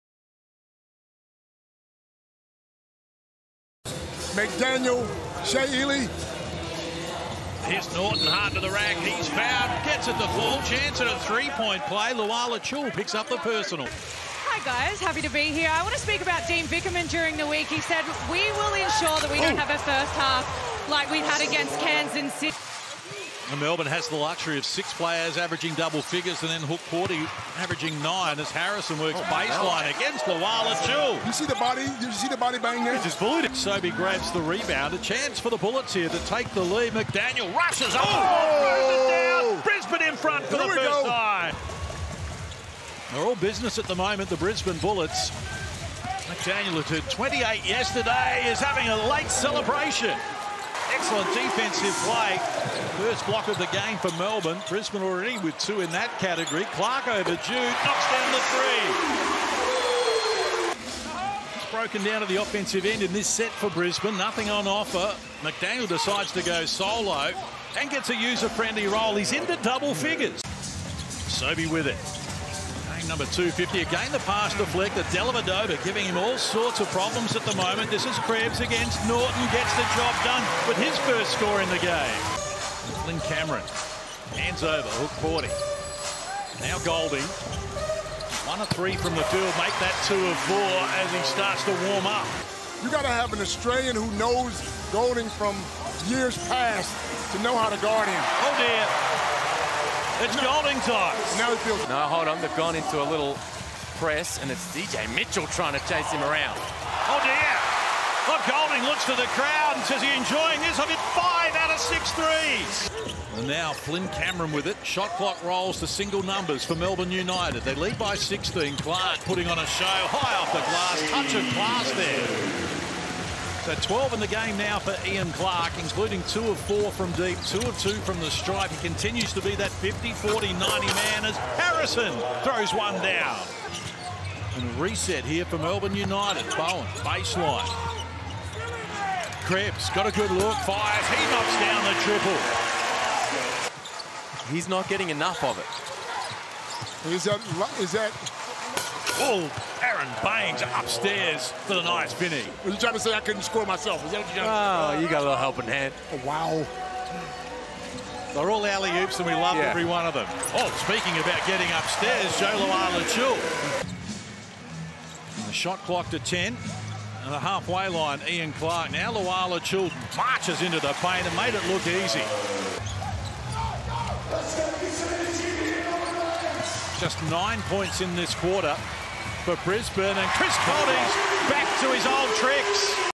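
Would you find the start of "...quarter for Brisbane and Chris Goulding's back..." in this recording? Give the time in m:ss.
2:58.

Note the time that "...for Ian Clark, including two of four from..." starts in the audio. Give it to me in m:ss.
2:04.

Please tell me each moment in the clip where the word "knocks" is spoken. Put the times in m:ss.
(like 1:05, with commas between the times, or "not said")
0:57, 2:21.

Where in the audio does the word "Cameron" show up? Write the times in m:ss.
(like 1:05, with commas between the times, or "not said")
1:23, 1:54.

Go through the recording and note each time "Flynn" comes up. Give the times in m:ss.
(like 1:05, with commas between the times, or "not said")
1:23, 1:53.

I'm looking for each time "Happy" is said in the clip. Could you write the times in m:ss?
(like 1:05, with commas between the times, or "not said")
0:15.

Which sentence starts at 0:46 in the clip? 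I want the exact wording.
McDaniel, who 28 yesterday, is having a late celebration excellent defensive play.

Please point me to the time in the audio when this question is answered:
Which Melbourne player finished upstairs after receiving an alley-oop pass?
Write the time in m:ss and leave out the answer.
2:29.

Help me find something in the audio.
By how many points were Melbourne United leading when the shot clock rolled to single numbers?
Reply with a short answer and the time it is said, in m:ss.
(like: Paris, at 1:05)
16, at 1:58.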